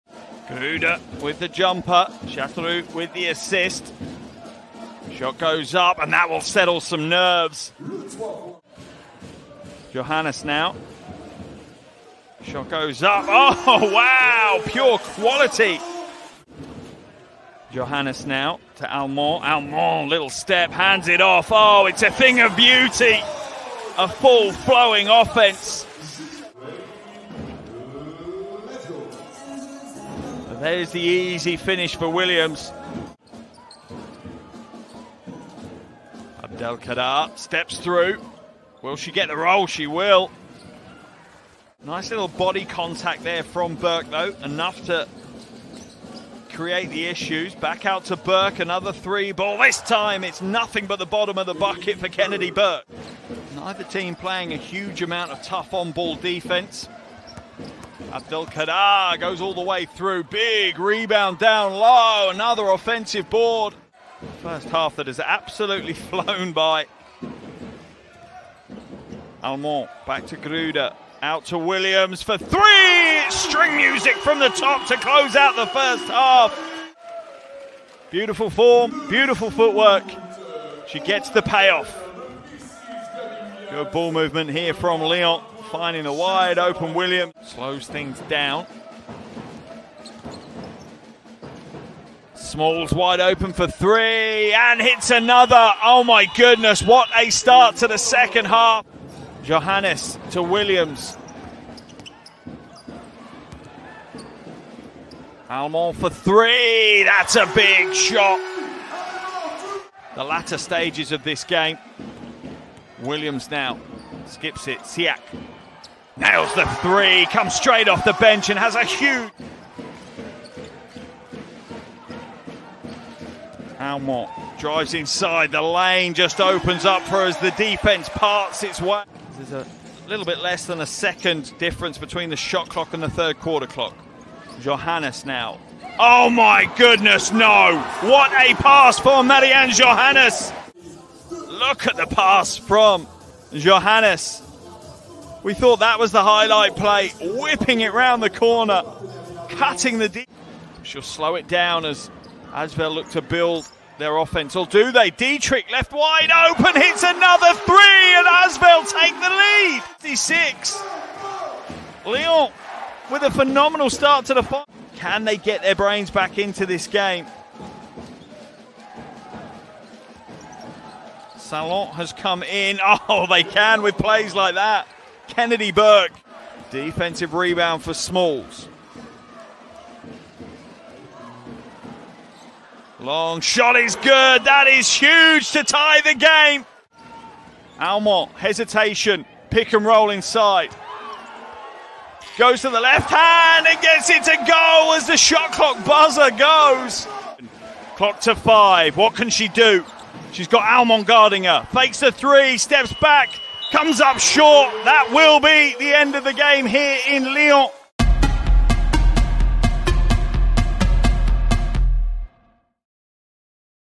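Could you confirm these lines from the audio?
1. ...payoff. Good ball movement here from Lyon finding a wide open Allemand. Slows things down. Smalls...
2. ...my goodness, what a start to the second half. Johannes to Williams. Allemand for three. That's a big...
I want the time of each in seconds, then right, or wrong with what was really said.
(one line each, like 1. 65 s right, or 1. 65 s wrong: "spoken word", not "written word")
1. 81 s wrong: "William", not "Allemand"
2. 96 s right.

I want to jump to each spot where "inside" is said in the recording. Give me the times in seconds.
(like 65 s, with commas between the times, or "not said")
124 s, 190 s.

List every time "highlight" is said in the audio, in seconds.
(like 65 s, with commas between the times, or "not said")
146 s.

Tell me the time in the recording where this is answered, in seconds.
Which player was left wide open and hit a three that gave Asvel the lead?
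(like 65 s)
155 s.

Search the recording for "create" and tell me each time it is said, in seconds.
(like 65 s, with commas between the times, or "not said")
46 s.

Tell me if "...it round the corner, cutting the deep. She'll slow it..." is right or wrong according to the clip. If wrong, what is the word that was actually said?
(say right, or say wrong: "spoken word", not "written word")
right.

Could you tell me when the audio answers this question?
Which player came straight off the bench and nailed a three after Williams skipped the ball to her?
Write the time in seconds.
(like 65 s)
114 s.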